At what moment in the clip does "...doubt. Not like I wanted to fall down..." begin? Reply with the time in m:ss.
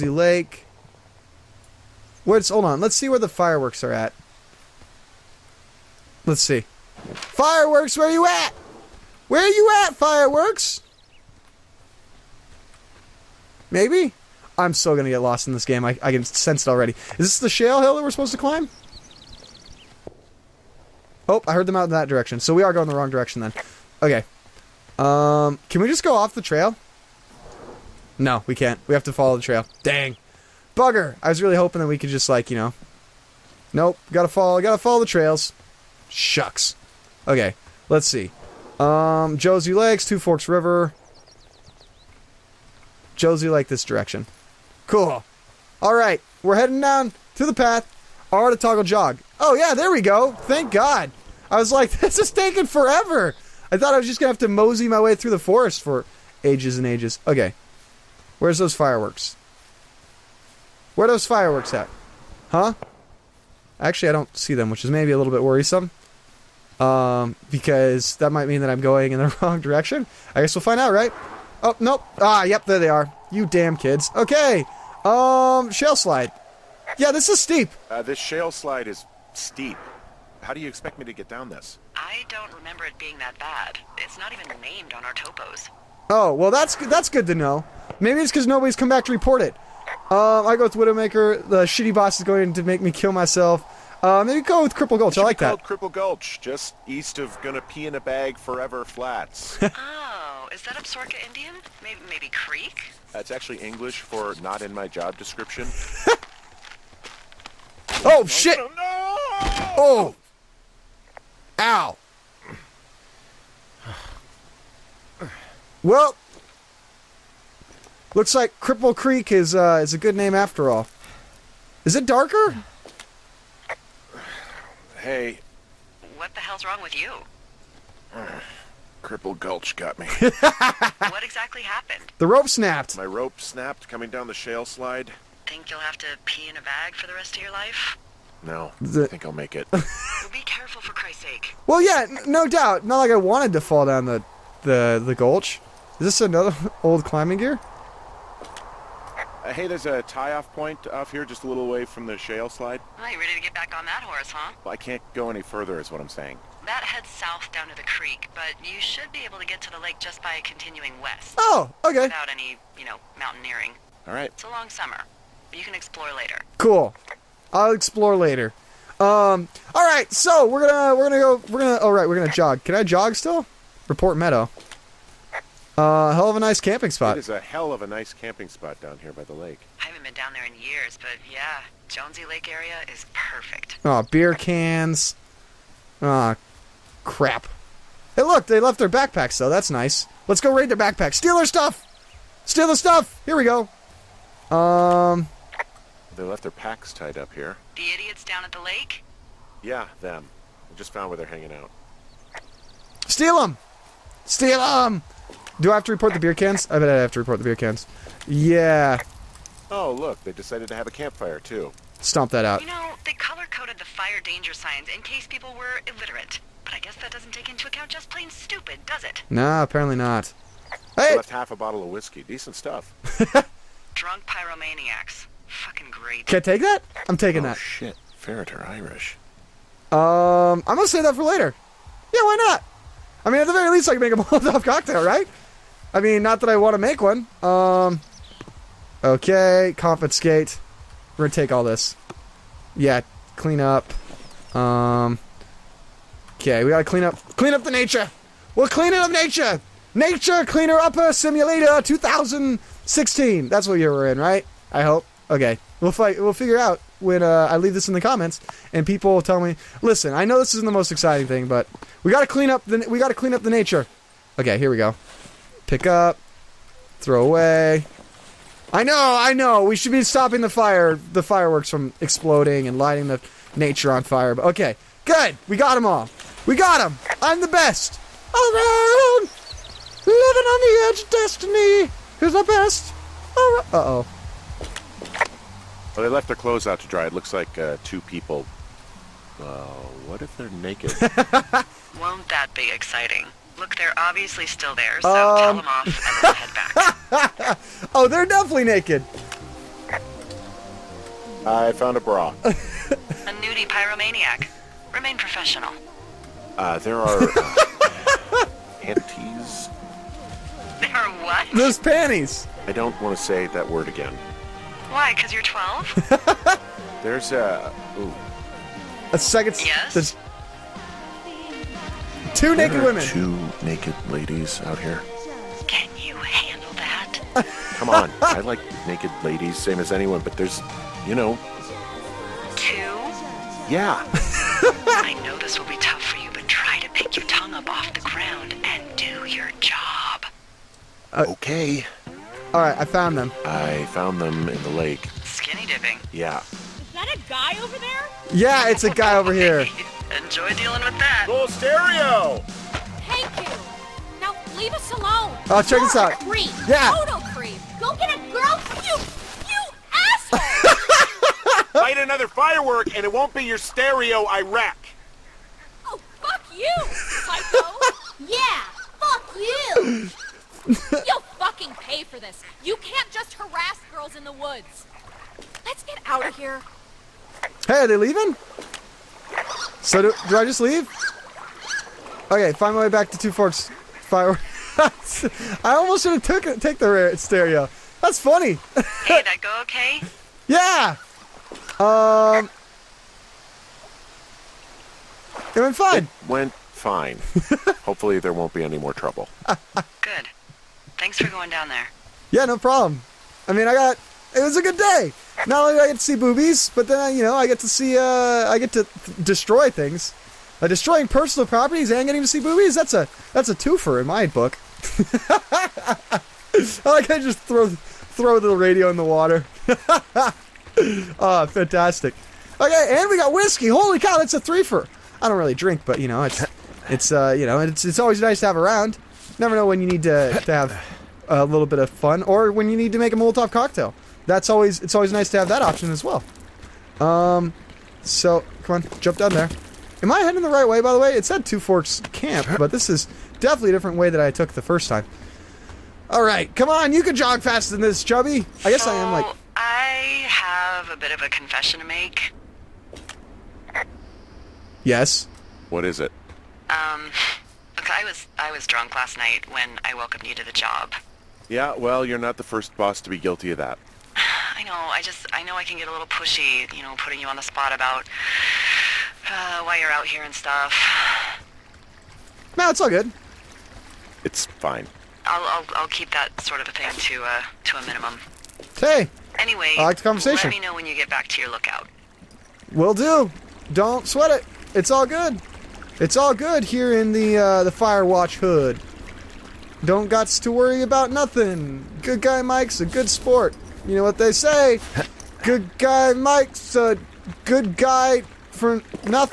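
2:22.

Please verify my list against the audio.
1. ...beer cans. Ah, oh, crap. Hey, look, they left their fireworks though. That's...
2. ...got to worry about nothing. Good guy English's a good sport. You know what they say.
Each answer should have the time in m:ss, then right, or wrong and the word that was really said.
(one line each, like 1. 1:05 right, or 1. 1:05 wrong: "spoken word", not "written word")
1. 3:04 wrong: "backpacks", not "fireworks"
2. 8:10 wrong: "Mike", not "English".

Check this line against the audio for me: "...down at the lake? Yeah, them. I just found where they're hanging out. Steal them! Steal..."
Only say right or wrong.
right.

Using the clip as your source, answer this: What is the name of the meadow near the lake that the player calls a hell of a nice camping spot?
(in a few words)
Report Meadow.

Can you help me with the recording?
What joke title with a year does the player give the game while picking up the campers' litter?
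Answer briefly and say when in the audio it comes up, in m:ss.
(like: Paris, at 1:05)
Nature Cleaner Upper Simulator 2016, at 4:09.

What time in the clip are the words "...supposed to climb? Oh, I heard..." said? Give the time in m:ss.
0:18.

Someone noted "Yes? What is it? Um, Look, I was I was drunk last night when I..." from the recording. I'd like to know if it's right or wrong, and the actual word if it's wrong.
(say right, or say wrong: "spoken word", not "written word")
right.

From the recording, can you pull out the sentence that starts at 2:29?
Uh, hey, there's a tie-off point off here, just a little away from the shale slide.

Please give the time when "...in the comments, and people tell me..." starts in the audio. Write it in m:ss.
4:17.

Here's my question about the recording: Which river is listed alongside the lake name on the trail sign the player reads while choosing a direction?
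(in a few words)
Two Forks River.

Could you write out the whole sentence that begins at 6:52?
That's a that's a twofer in my book.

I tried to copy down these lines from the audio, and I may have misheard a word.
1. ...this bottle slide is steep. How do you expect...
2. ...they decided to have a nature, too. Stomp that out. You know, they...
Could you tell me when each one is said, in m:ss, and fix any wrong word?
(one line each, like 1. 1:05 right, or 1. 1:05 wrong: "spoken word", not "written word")
1. 1:18 wrong: "shale", not "bottle"
2. 3:30 wrong: "campfire", not "nature".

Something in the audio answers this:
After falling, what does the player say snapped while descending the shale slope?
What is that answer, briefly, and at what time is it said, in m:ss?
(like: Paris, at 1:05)
My rope, at 2:12.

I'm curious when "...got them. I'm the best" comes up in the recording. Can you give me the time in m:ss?
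4:36.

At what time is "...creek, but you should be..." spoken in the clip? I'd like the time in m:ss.
2:37.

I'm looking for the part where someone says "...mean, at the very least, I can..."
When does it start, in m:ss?
3:53.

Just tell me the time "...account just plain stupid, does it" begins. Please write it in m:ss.
3:37.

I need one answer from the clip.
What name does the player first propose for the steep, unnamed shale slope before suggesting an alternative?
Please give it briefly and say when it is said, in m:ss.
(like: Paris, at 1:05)
Widowmaker, at 1:30.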